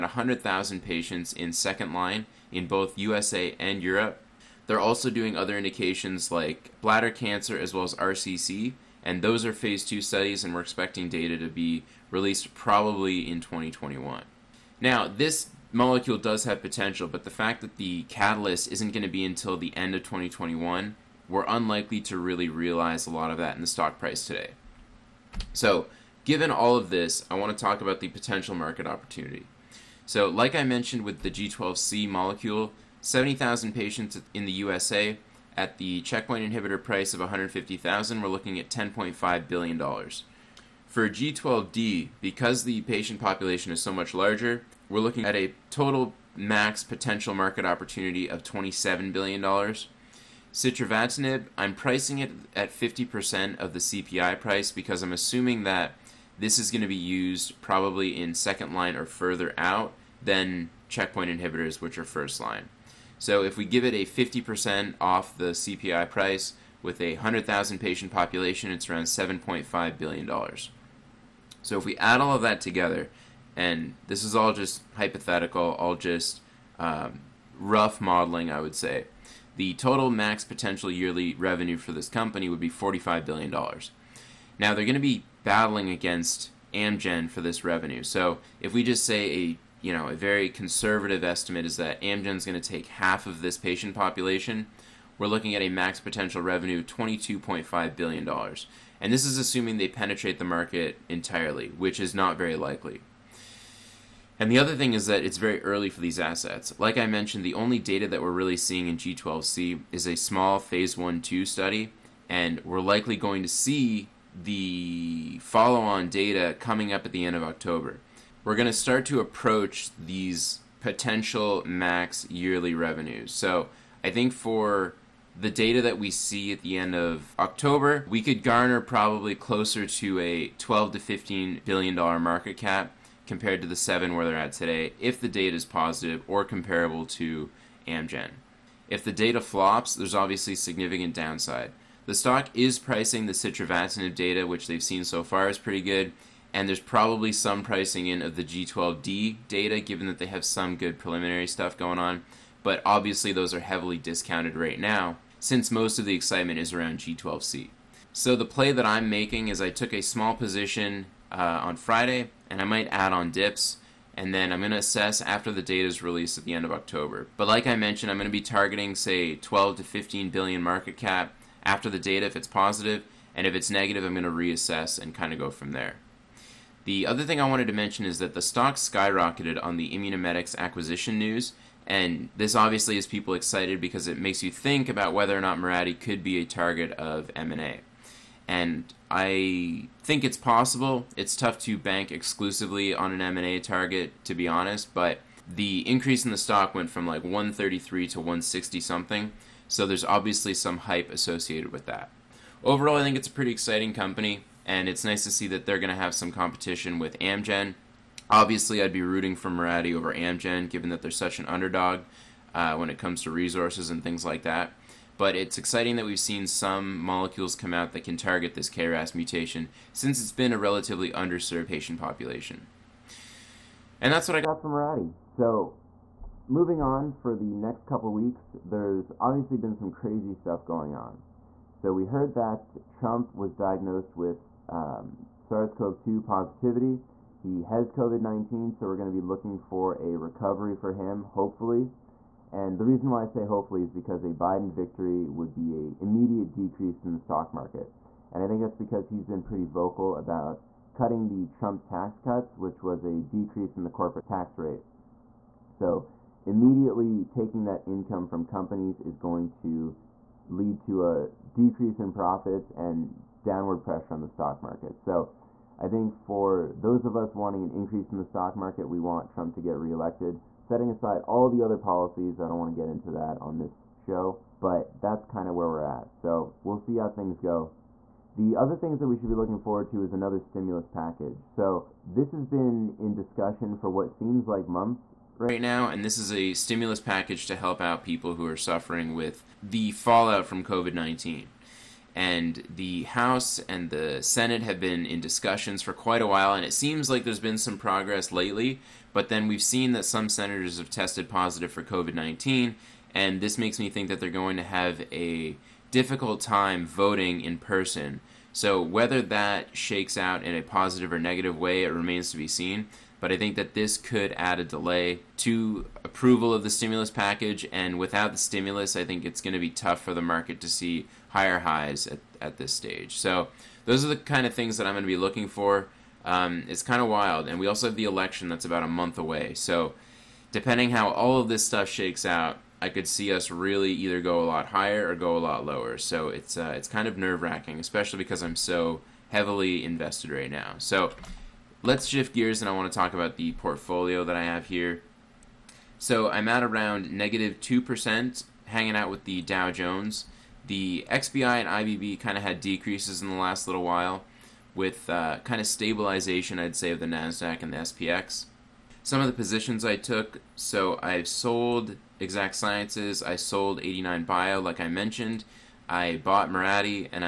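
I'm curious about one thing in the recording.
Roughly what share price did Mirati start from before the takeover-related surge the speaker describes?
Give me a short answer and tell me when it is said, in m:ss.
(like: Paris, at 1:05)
133, at 3:17.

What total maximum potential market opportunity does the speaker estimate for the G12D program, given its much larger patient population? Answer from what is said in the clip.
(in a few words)
$27 billion.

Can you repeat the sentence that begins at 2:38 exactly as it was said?
So the play that I'm making is I took a small position uh, on Friday, and I might add on dips.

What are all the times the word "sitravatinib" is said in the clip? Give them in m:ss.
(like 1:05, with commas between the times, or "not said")
0:50, 2:23.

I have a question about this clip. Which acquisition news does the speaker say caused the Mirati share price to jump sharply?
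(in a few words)
Immunomedics.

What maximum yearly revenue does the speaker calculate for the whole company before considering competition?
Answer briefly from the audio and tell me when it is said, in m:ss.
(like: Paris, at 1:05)
$45 billion, at 1:22.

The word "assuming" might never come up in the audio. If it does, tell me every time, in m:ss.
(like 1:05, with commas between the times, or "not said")
0:55, 1:39.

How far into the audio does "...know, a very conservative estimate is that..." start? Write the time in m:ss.
1:29.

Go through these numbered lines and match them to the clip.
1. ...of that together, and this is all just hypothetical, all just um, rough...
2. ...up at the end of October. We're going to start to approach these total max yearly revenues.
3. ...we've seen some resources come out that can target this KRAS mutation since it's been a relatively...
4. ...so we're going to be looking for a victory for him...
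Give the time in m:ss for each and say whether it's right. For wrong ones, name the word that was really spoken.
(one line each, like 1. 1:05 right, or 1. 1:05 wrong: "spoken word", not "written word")
1. 1:12 right
2. 1:56 wrong: "potential", not "total"
3. 3:36 wrong: "molecules", not "resources"
4. 3:58 wrong: "recovery", not "victory".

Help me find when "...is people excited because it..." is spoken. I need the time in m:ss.
3:02.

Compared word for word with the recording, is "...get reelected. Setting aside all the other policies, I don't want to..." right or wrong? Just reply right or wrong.
right.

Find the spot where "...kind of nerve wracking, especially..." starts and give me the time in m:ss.
5:36.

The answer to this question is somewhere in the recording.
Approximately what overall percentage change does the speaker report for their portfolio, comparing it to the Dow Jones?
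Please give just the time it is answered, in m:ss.
5:47.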